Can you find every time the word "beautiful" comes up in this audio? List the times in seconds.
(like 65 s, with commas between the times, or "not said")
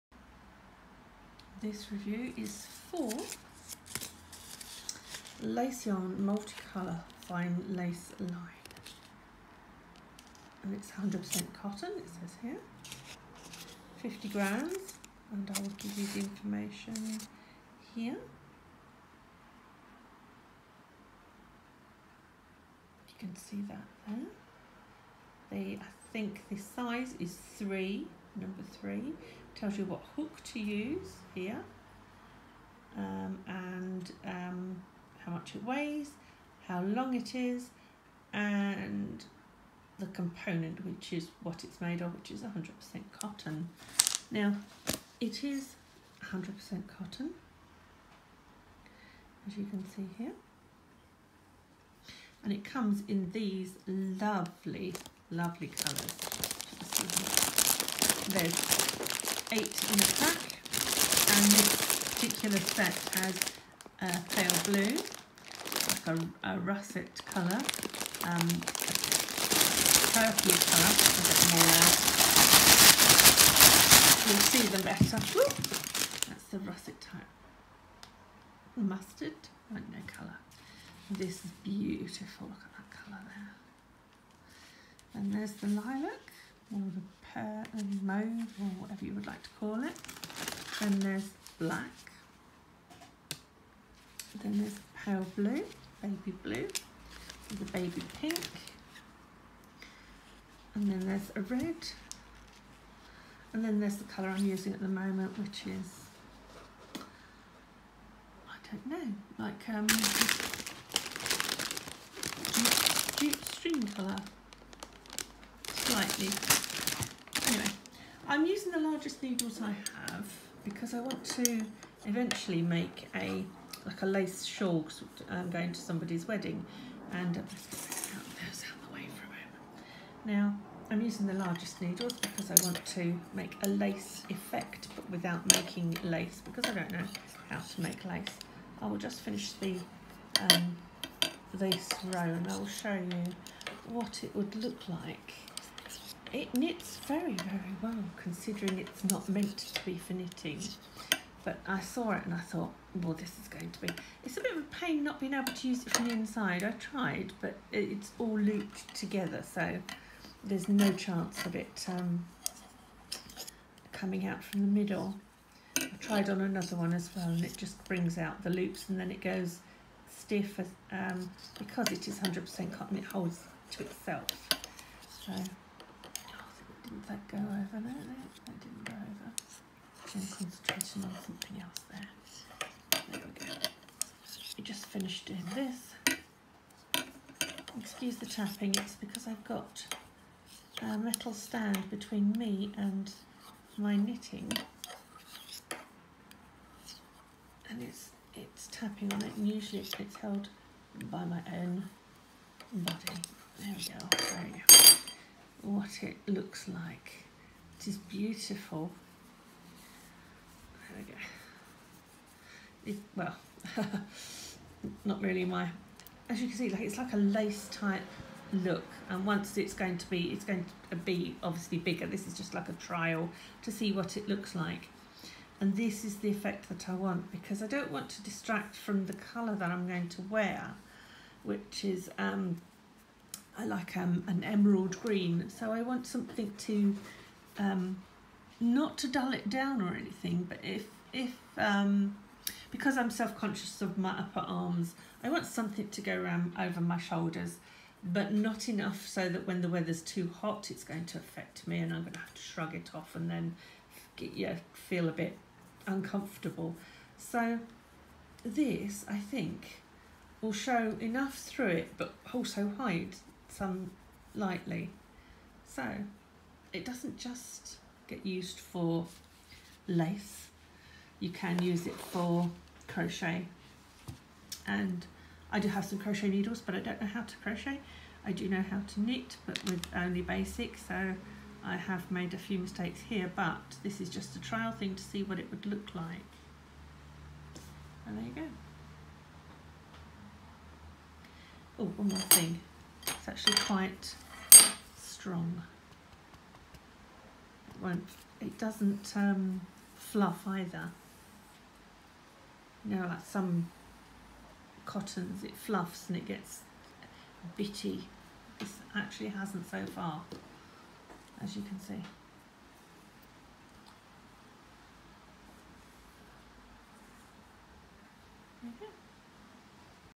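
81 s, 207 s.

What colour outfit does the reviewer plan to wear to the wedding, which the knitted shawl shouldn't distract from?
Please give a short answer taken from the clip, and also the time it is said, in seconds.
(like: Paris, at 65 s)
Emerald green, at 234 s.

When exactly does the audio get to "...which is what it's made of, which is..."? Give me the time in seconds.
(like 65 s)
40 s.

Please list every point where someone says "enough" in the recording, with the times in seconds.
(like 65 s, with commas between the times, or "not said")
248 s, 260 s.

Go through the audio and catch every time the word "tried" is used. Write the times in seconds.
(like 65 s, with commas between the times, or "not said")
156 s, 165 s.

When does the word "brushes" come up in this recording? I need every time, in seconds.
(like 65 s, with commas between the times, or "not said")
not said.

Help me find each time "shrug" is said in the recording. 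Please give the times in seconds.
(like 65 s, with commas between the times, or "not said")
252 s.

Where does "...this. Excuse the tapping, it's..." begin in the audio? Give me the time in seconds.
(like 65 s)
185 s.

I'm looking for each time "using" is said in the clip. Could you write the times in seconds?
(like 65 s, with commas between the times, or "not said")
104 s, 118 s, 131 s.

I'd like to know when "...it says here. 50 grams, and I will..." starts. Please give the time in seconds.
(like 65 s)
11 s.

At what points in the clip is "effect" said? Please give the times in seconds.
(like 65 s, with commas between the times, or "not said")
134 s, 226 s.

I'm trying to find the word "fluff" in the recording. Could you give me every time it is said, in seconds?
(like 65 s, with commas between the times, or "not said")
299 s, 305 s.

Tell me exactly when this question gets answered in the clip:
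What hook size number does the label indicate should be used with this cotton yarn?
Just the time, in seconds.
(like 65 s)
28 s.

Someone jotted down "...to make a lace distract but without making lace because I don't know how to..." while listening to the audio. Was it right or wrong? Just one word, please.
wrong.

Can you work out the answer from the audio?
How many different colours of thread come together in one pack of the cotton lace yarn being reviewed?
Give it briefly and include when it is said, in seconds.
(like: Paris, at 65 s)
8, at 58 s.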